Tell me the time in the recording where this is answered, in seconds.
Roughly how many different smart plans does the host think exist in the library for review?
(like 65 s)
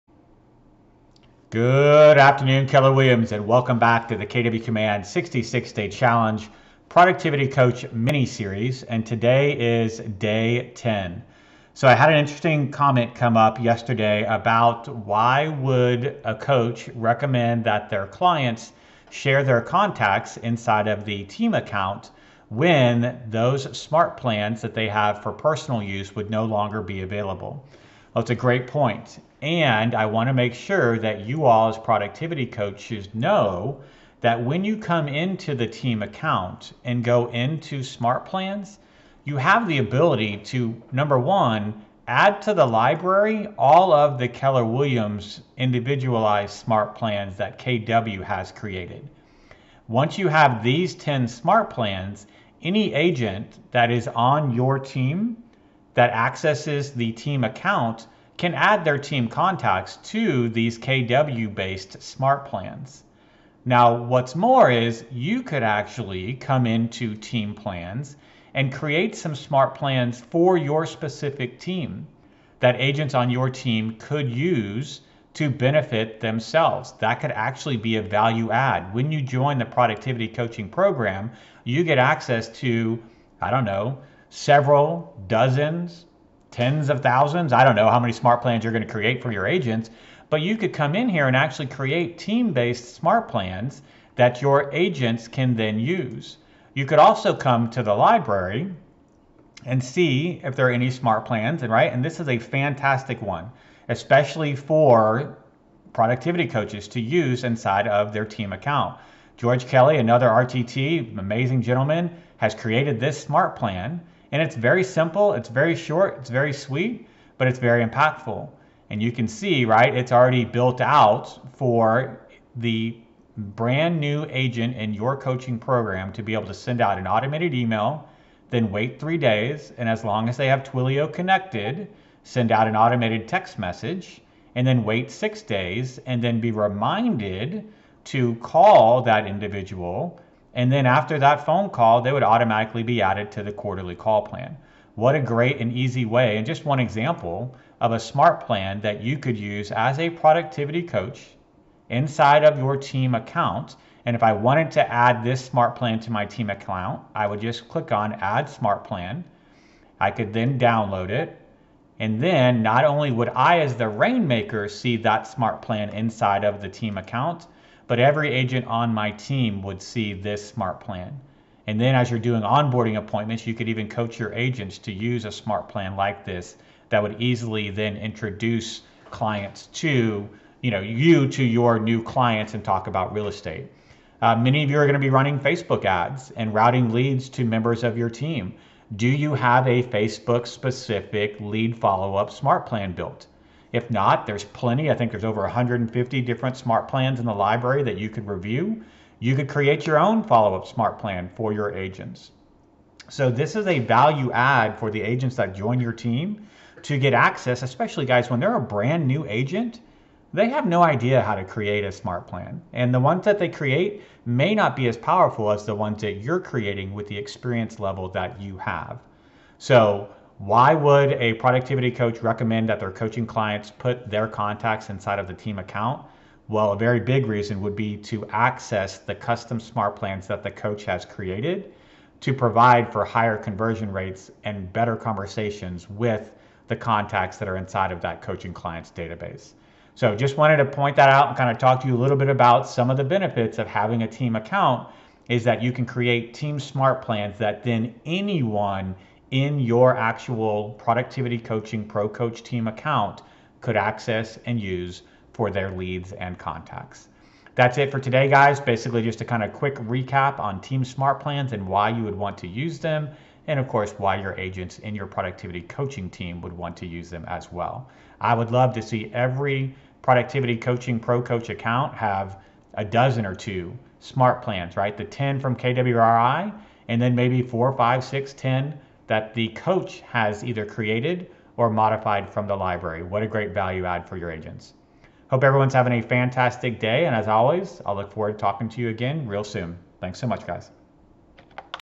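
195 s.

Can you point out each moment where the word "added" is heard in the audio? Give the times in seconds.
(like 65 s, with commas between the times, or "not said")
143 s.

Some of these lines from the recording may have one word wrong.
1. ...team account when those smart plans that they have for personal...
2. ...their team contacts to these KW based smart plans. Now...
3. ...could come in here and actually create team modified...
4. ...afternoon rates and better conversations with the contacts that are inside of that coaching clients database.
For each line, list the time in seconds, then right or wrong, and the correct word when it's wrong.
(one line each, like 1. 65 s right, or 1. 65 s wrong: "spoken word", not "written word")
1. 21 s right
2. 58 s right
3. 90 s wrong: "based", not "modified"
4. 233 s wrong: "conversion", not "afternoon".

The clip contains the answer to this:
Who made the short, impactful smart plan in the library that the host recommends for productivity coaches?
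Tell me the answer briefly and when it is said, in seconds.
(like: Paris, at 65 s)
George Kelly, at 109 s.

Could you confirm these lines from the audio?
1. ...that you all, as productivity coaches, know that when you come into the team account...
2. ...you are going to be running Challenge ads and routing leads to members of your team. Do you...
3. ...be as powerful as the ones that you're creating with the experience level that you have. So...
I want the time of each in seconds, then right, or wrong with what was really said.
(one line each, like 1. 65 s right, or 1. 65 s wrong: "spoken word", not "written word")
1. 30 s right
2. 184 s wrong: "Facebook", not "Challenge"
3. 214 s right.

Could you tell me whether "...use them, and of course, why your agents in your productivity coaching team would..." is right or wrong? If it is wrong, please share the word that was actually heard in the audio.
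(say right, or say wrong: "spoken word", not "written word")
right.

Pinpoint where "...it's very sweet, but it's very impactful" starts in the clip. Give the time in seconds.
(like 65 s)
116 s.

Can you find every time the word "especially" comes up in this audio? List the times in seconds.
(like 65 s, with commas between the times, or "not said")
103 s, 207 s.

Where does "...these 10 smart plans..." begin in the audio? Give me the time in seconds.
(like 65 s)
50 s.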